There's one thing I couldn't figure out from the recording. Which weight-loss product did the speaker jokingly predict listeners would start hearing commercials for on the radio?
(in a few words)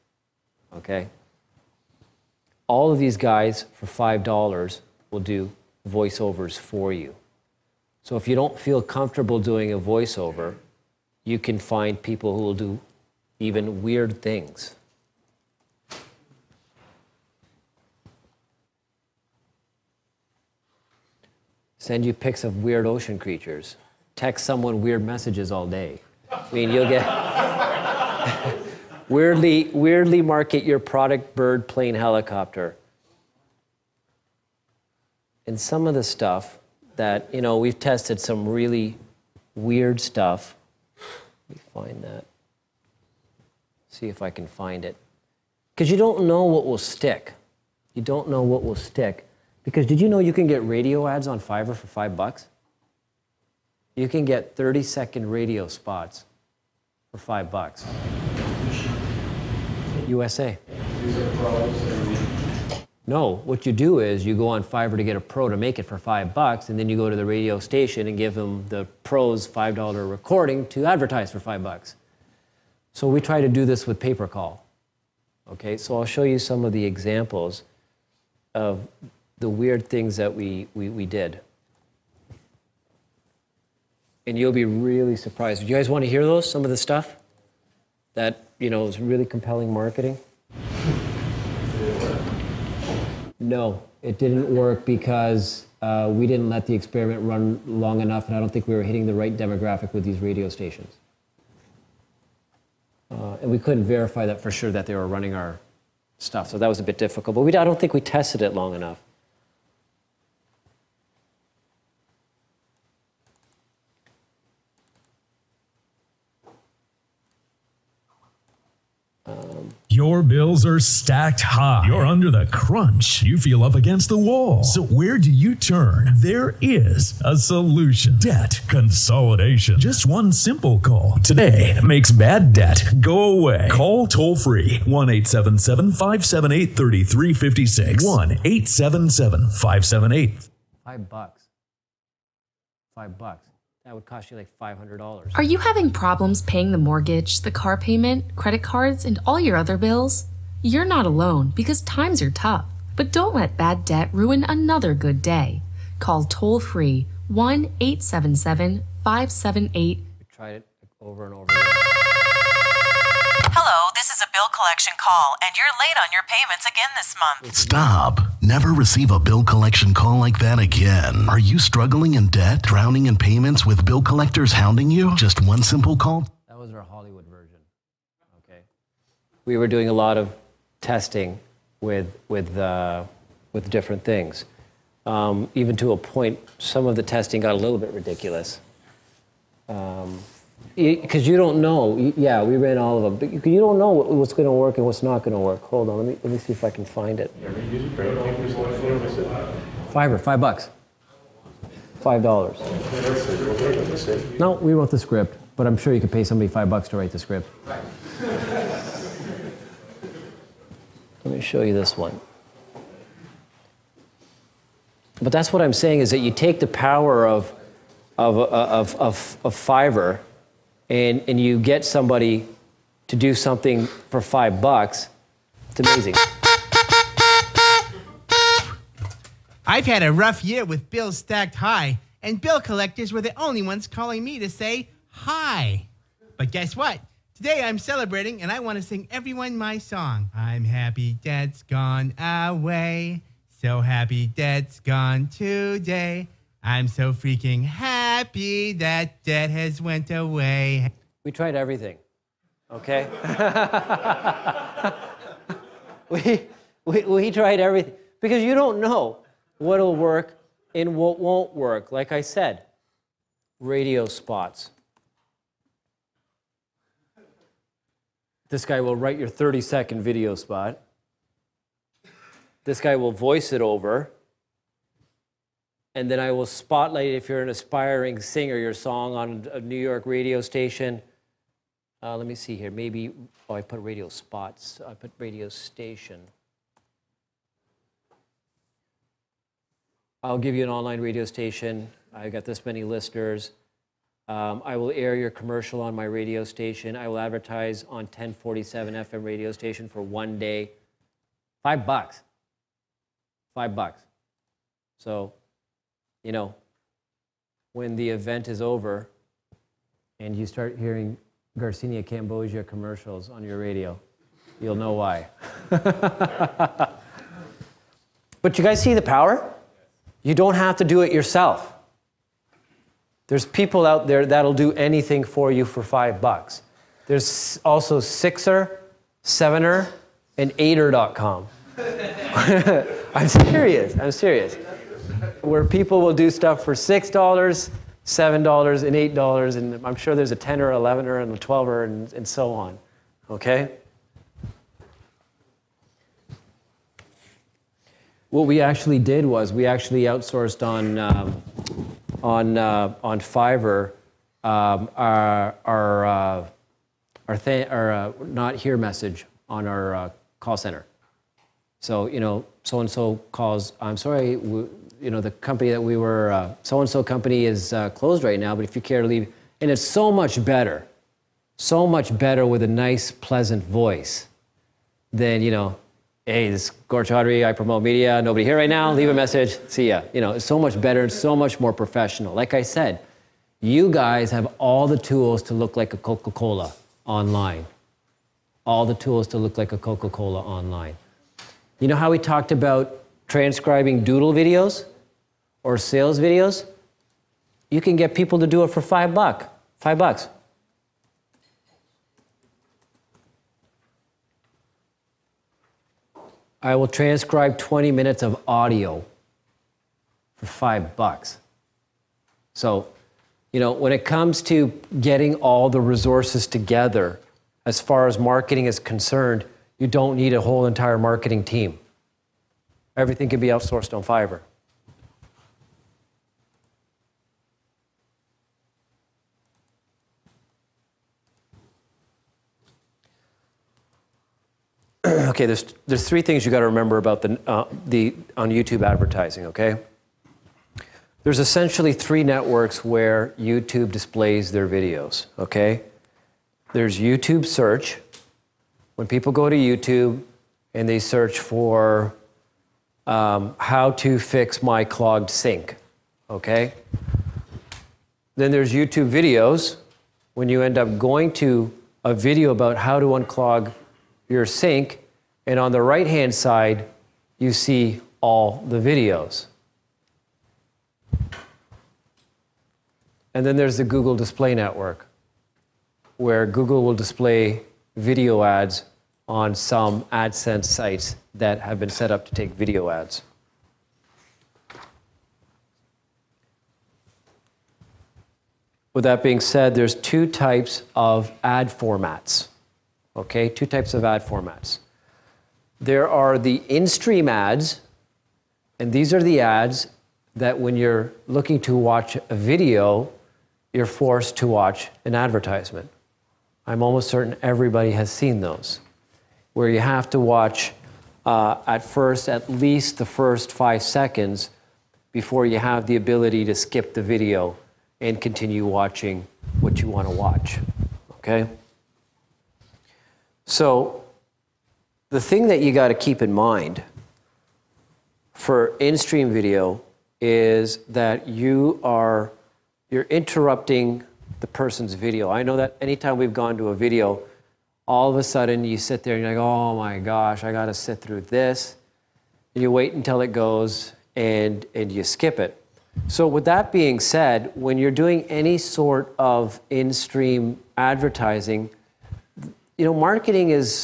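Garcinia Cambogia.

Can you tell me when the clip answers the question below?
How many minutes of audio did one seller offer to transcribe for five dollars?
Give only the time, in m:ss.
6:47.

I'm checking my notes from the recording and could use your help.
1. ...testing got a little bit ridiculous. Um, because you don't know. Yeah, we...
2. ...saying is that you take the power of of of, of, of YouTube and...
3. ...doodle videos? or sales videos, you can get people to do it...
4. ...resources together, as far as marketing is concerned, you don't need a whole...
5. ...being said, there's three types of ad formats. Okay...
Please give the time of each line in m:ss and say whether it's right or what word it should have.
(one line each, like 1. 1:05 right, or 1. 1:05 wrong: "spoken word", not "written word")
1. 3:07 right
2. 3:35 wrong: "Fiverr", not "YouTube"
3. 6:34 right
4. 6:55 right
5. 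8:09 wrong: "two", not "three".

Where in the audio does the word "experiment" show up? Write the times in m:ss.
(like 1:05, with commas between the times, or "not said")
1:36.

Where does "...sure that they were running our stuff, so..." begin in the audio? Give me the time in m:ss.
1:44.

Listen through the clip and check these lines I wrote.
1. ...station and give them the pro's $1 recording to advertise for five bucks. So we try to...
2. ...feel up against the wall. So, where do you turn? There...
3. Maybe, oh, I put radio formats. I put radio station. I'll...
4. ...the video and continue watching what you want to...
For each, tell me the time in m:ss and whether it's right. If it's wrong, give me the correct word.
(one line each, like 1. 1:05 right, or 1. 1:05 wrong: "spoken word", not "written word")
1. 1:07 wrong: "5", not "1"
2. 2:03 right
3. 4:42 wrong: "spots", not "formats"
4. 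8:36 right.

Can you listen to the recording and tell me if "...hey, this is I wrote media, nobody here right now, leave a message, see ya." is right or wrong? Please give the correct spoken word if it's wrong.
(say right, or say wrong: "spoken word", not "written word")
wrong: "promote", not "wrote".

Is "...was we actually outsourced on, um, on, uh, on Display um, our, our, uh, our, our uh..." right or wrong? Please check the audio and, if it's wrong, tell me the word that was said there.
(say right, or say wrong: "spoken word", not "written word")
wrong: "Fiverr", not "Display".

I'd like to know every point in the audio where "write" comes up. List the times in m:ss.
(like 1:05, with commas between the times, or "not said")
3:26, 4:28.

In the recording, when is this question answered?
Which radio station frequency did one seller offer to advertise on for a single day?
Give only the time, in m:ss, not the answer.
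4:58.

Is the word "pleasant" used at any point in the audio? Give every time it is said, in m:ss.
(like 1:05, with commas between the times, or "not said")
6:13.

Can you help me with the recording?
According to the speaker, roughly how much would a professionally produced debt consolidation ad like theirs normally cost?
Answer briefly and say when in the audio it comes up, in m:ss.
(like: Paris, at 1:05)
$500, at 2:24.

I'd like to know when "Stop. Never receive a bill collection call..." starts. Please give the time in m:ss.
2:47.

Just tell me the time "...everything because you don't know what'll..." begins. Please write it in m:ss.
4:17.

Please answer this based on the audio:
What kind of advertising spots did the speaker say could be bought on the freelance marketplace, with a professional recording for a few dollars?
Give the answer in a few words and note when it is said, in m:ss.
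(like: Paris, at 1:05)
30 second radio spots, at 0:54.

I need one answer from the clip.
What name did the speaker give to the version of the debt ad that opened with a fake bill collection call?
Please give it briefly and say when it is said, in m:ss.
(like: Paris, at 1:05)
Hollywood version, at 2:56.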